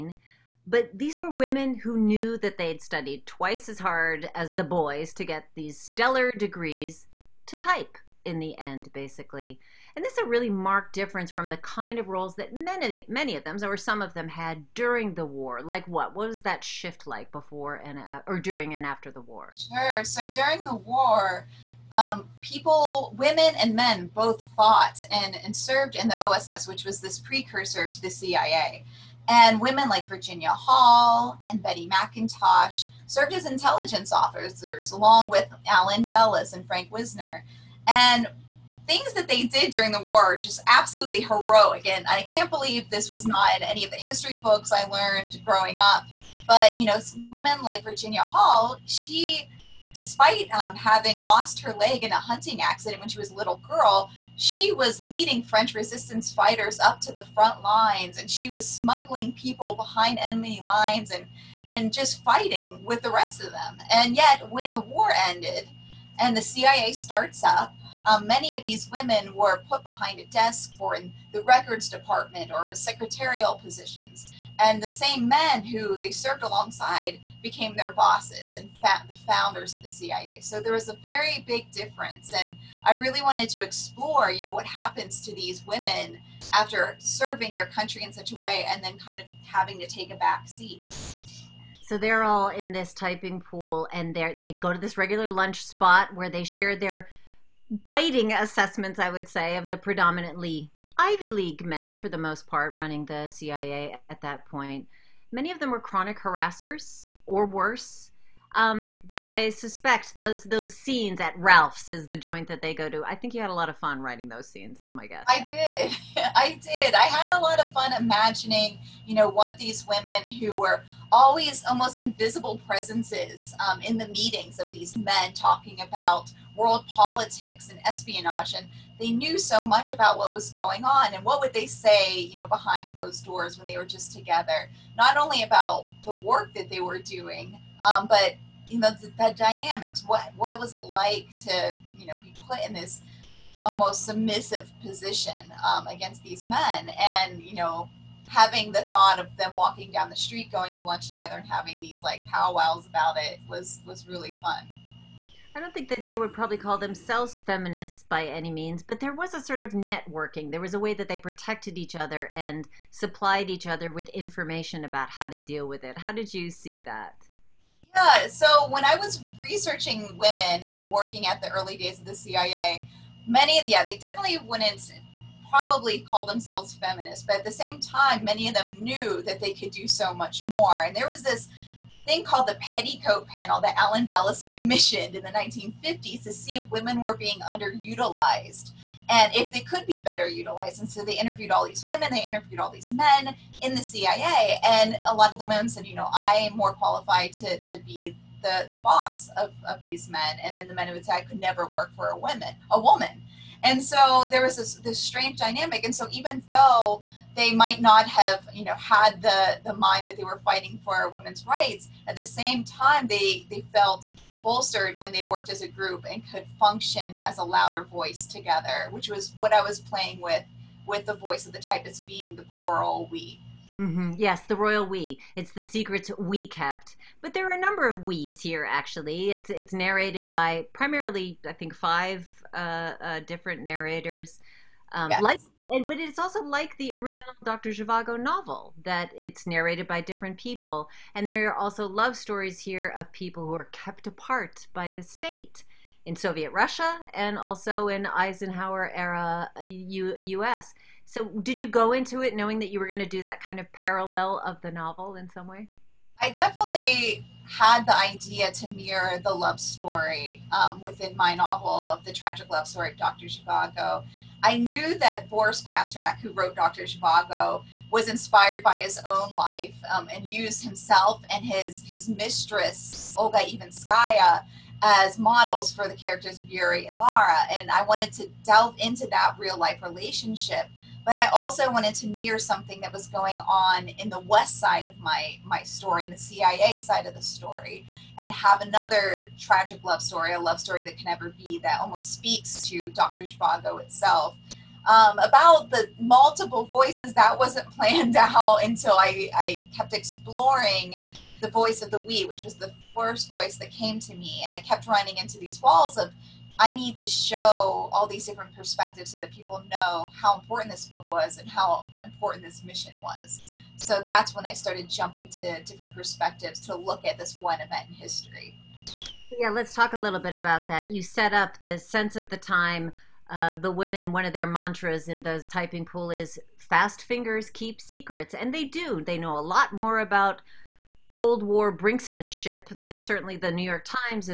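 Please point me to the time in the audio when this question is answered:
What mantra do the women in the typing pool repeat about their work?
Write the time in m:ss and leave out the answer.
5:26.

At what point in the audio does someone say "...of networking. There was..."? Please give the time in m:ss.
2:39.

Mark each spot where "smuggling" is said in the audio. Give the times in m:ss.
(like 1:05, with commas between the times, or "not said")
0:58.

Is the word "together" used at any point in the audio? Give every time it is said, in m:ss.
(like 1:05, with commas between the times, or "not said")
2:14, 2:31, 3:38.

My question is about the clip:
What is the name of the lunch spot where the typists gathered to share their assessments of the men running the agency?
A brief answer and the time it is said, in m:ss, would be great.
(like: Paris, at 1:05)
Ralph's, at 1:51.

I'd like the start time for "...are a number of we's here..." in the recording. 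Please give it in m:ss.
3:47.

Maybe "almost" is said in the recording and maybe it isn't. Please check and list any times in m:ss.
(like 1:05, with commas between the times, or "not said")
2:01, 2:23, 4:51.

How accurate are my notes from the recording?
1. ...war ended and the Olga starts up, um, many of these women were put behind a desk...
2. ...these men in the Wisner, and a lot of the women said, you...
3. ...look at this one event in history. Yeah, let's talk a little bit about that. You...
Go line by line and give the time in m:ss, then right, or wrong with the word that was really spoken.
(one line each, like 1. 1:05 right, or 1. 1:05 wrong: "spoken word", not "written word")
1. 1:04 wrong: "CIA", not "Olga"
2. 3:12 wrong: "CIA", not "Wisner"
3. 5:16 right.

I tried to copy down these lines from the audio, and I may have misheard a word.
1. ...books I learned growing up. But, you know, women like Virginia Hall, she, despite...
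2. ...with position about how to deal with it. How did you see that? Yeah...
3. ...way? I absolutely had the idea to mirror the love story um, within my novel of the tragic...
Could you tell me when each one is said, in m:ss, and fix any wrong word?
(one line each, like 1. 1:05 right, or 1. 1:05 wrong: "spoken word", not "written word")
1. 0:44 right
2. 2:43 wrong: "information", not "position"
3. 4:15 wrong: "definitely", not "absolutely".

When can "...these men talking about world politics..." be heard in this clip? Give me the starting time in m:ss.
2:04.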